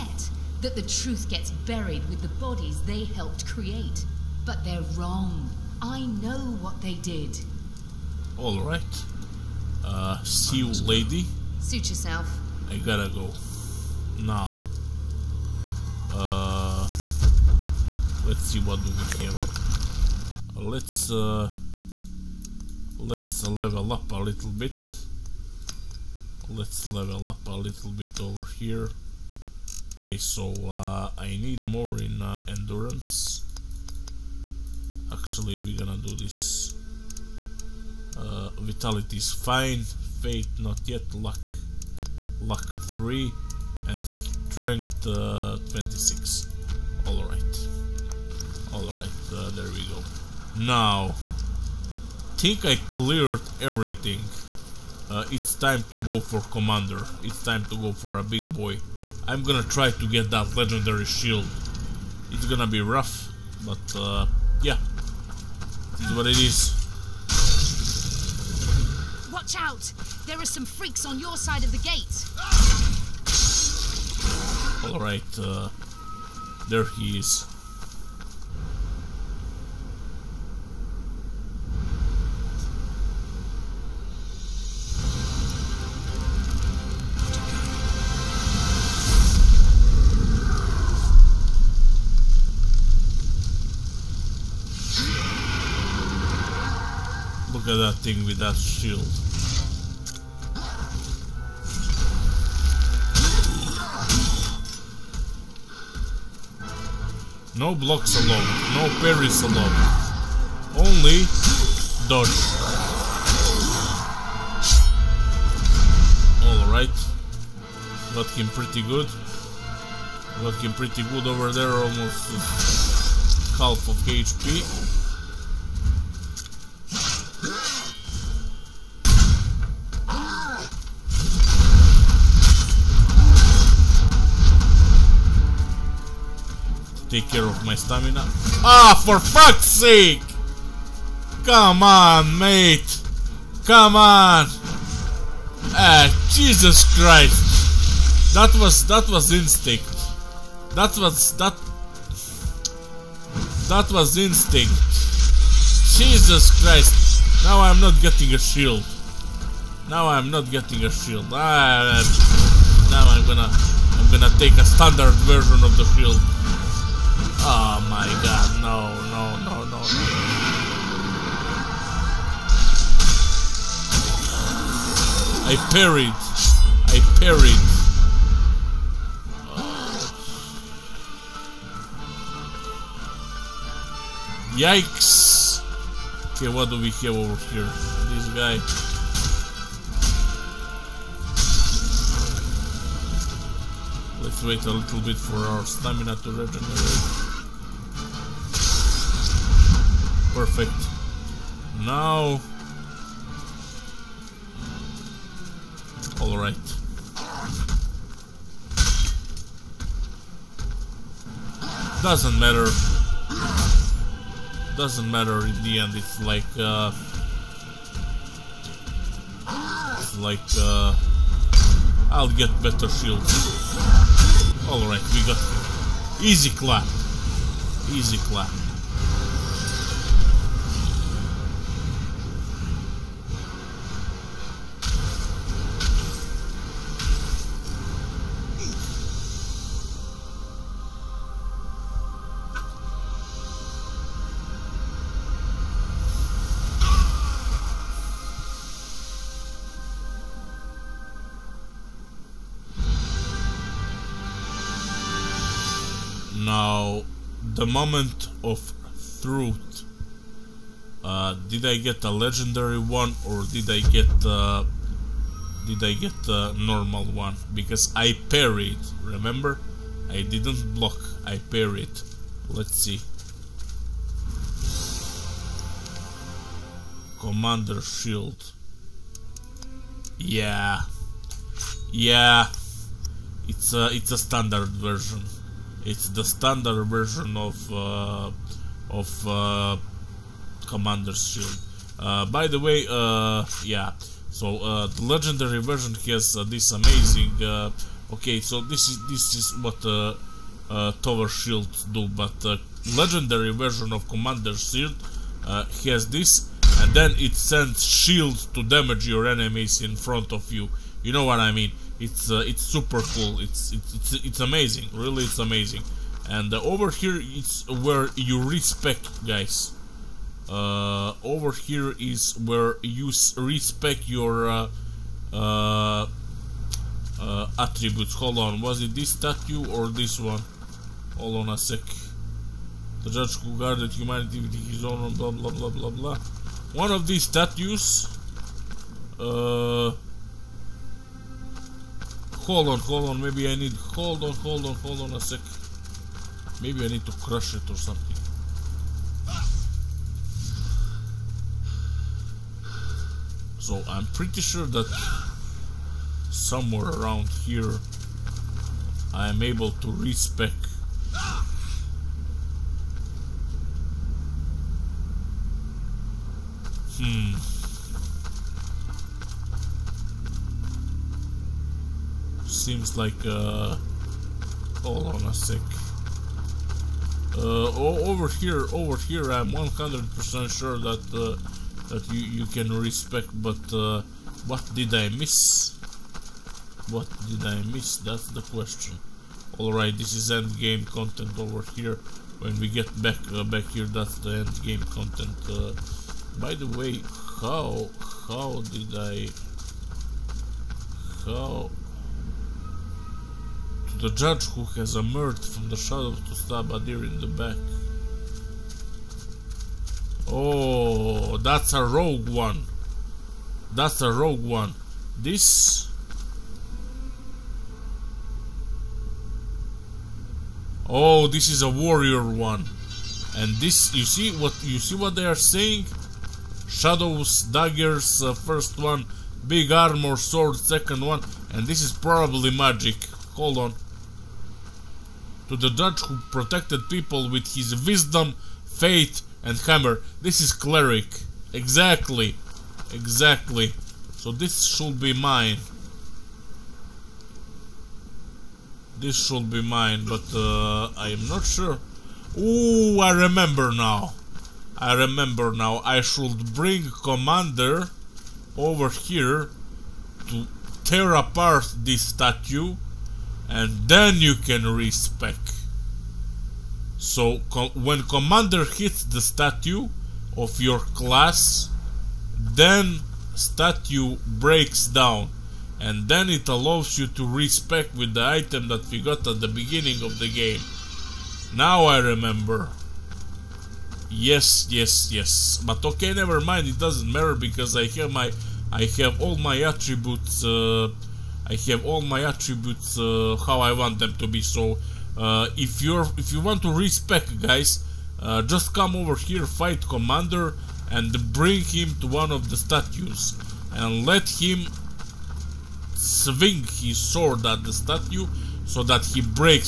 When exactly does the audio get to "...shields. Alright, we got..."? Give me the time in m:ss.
3:42.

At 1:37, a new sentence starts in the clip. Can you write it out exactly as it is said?
look at that thing with that shield.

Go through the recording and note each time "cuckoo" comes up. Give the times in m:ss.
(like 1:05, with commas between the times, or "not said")
not said.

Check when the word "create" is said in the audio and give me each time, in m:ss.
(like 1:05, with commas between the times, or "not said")
0:03.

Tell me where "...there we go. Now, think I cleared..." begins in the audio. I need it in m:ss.
0:49.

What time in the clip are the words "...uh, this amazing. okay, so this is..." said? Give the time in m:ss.
4:56.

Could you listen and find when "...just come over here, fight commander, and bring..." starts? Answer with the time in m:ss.
8:18.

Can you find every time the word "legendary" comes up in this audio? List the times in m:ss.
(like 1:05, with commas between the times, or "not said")
1:00, 4:22, 4:55, 5:02.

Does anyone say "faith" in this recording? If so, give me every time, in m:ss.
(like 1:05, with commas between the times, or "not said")
7:18.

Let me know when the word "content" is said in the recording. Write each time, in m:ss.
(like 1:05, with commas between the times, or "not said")
6:30, 6:34.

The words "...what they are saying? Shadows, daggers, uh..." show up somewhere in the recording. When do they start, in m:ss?
7:04.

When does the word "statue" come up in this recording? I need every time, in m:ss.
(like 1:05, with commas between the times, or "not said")
5:29, 5:37, 7:42, 7:49, 7:53, 8:22, 8:27.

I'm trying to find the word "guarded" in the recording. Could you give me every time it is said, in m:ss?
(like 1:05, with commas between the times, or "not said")
5:33.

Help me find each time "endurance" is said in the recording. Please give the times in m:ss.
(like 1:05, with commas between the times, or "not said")
0:32.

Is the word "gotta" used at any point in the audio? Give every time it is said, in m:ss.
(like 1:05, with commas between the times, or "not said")
0:12.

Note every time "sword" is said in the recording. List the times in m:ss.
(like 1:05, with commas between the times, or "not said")
7:10, 8:26.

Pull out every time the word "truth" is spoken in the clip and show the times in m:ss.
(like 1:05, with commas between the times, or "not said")
0:00, 4:19.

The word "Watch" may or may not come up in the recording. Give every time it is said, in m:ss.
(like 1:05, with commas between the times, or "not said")
1:09.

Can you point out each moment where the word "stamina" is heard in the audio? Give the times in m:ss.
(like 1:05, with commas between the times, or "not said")
2:17, 3:15.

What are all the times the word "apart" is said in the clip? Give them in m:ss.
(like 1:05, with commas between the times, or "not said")
7:41.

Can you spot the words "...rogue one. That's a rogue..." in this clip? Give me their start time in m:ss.
6:51.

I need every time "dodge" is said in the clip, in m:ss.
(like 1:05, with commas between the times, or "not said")
1:52.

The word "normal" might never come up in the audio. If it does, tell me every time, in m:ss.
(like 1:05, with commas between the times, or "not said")
4:26.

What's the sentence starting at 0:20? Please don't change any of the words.
Let's, uh, let's level up a little bit.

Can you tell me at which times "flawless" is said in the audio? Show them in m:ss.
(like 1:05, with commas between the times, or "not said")
not said.